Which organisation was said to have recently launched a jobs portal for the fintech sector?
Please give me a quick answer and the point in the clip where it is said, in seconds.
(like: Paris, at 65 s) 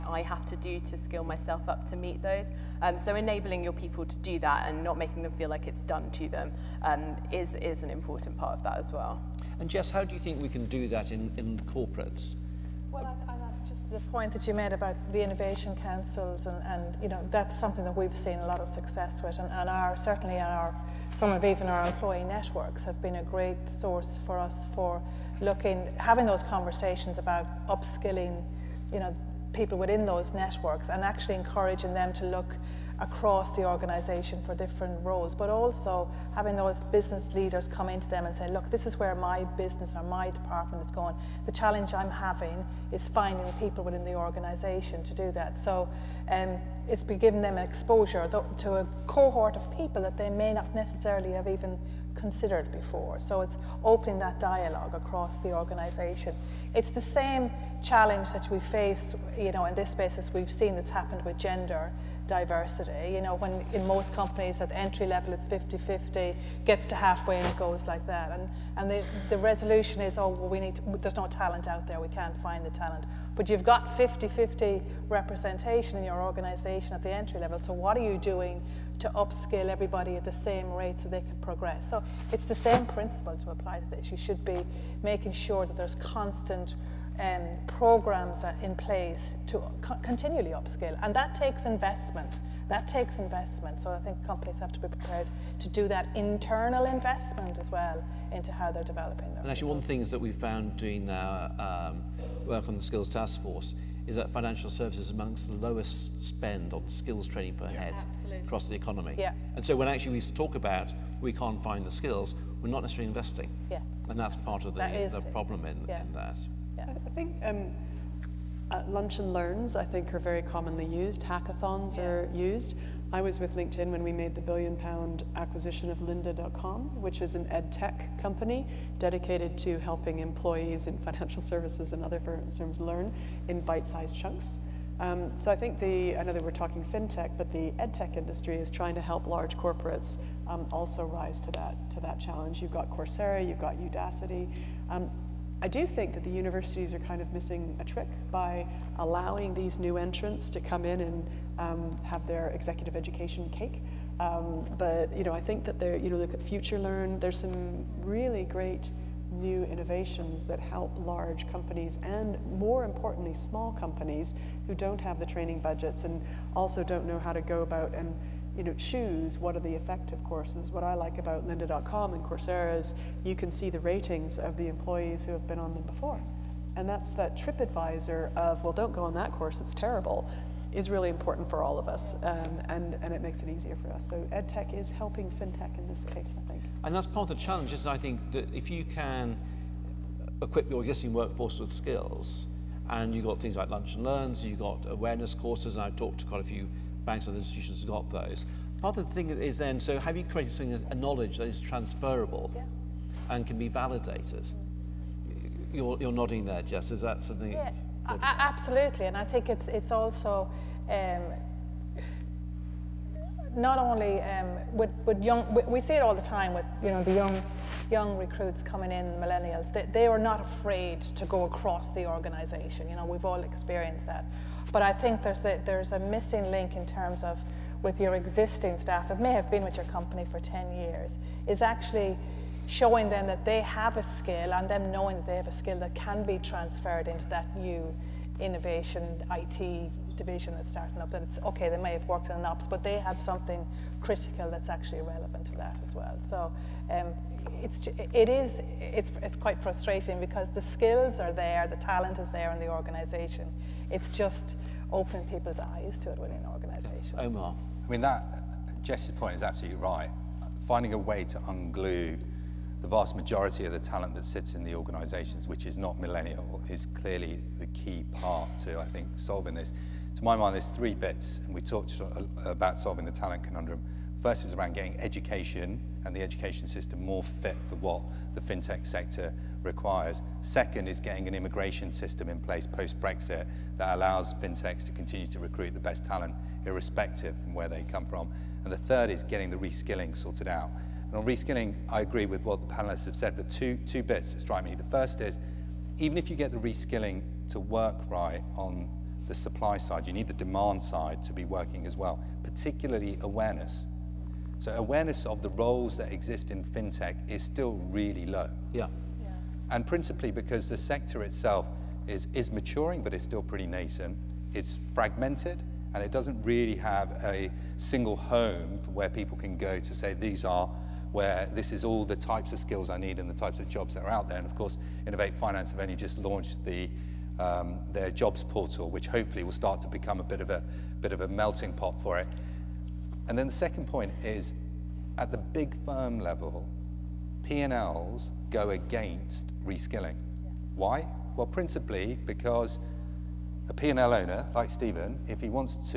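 Innovate Finance, at 325 s.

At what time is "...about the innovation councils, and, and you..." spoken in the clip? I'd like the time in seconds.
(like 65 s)
14 s.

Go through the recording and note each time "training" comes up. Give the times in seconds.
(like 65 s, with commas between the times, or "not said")
107 s, 165 s.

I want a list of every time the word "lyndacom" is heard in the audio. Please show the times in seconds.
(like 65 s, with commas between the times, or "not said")
125 s, 171 s.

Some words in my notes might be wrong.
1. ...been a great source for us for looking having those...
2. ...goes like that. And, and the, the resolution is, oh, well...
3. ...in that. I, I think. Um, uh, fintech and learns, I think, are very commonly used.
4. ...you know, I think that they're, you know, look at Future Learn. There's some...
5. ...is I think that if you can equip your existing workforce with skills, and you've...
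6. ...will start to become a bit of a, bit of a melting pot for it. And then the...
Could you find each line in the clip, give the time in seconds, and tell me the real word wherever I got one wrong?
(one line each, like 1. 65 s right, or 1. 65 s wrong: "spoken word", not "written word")
1. 23 s right
2. 67 s right
3. 115 s wrong: "lunch", not "fintech"
4. 155 s right
5. 187 s right
6. 329 s right.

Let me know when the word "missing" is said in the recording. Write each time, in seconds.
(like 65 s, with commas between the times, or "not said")
147 s, 225 s.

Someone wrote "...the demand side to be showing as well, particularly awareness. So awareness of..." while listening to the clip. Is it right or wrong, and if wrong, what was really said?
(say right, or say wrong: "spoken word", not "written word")
wrong: "working", not "showing".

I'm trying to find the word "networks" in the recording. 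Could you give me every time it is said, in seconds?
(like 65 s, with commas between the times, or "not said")
22 s, 30 s.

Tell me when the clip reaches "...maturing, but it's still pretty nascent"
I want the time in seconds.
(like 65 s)
312 s.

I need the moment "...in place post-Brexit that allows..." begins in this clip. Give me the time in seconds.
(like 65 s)
282 s.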